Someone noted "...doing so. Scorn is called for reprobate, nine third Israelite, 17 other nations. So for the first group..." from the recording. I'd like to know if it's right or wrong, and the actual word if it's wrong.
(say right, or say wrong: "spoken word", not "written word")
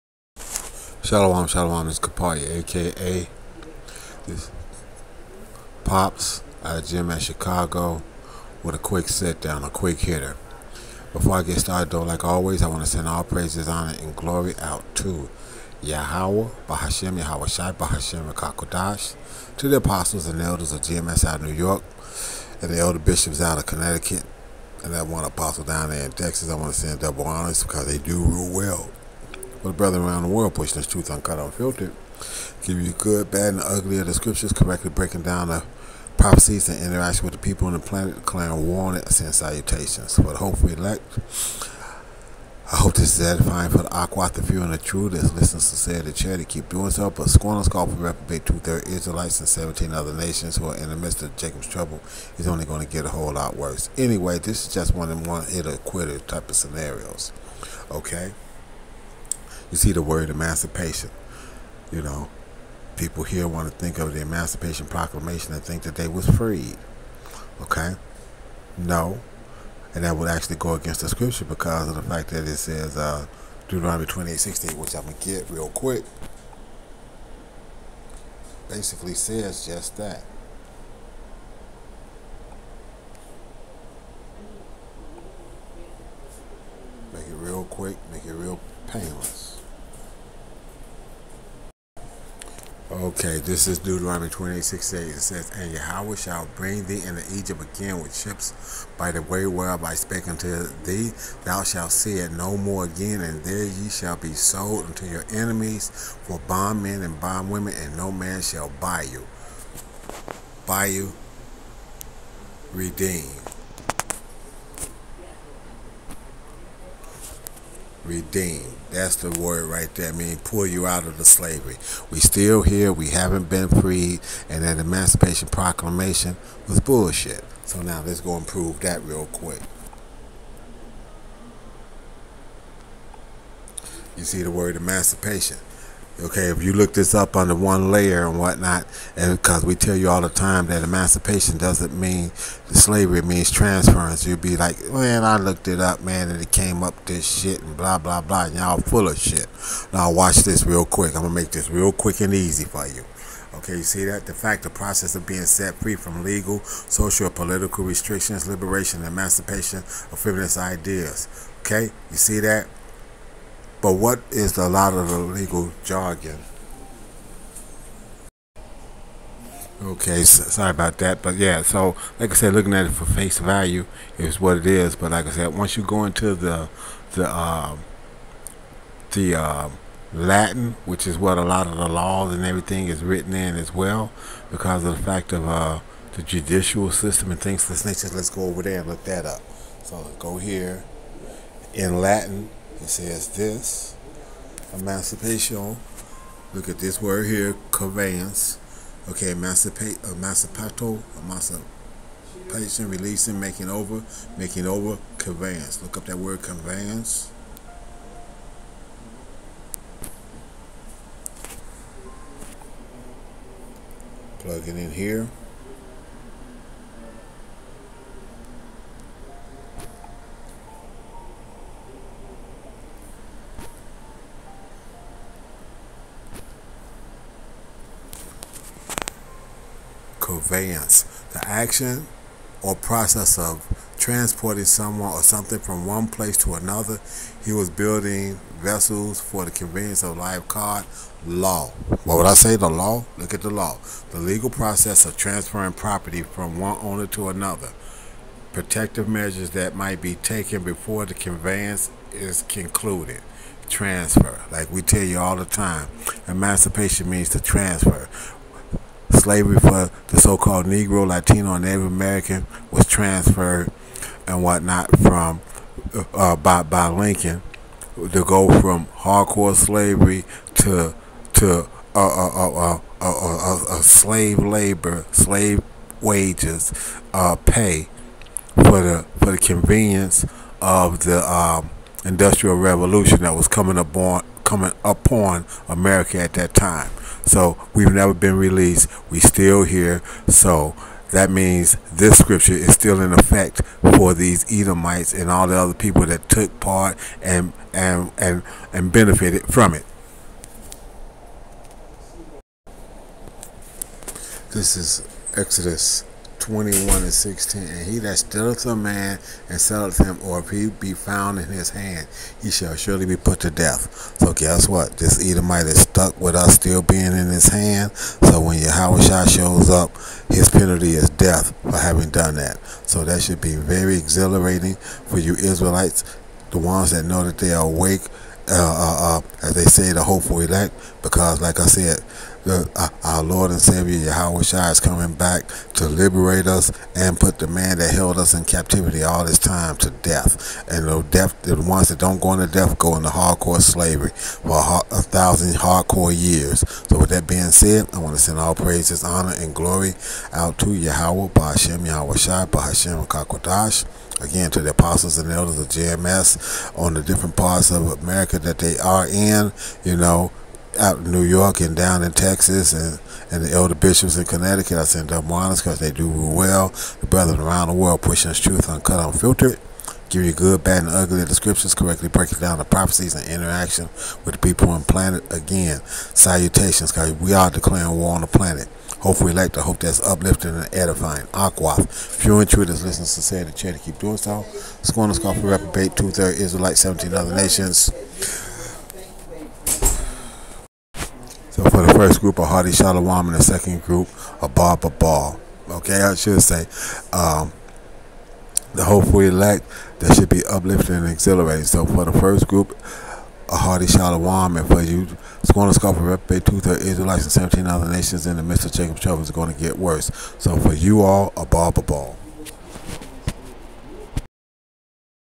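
wrong: "two", not "nine".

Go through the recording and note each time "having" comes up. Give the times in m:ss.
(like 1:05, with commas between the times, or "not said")
5:21.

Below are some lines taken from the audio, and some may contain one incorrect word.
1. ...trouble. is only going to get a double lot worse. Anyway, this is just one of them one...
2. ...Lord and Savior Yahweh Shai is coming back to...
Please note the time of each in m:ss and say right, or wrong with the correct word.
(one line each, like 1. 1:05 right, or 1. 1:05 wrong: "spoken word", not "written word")
1. 0:51 wrong: "whole", not "double"
2. 5:33 right.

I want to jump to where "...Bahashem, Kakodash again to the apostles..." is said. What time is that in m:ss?
5:52.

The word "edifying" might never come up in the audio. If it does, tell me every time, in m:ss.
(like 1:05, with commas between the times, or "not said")
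0:43, 6:20.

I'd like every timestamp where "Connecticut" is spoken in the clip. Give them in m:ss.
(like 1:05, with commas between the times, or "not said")
0:23, 6:04.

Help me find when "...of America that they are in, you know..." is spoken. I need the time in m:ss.
5:57.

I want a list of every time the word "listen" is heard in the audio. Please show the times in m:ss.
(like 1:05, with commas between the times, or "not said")
0:45, 6:22.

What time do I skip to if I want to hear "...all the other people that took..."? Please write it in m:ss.
4:55.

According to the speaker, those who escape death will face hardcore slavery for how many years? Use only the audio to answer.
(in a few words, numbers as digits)
1000.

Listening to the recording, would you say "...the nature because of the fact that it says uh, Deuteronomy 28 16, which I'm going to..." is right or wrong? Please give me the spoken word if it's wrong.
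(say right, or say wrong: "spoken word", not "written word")
wrong: "scripture", not "nature".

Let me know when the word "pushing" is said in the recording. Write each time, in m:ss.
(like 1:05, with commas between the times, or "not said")
0:30, 6:08.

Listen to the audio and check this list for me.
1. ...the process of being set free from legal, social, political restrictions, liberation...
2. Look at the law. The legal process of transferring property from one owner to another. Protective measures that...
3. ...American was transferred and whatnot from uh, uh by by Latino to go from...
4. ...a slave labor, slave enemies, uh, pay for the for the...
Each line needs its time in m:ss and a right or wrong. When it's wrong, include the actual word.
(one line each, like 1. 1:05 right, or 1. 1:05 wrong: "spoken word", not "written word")
1. 2:34 right
2. 4:03 right
3. 4:21 wrong: "Lincoln", not "Latino"
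4. 4:33 wrong: "wages", not "enemies".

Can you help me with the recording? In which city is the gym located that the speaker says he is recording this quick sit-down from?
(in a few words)
Chicago.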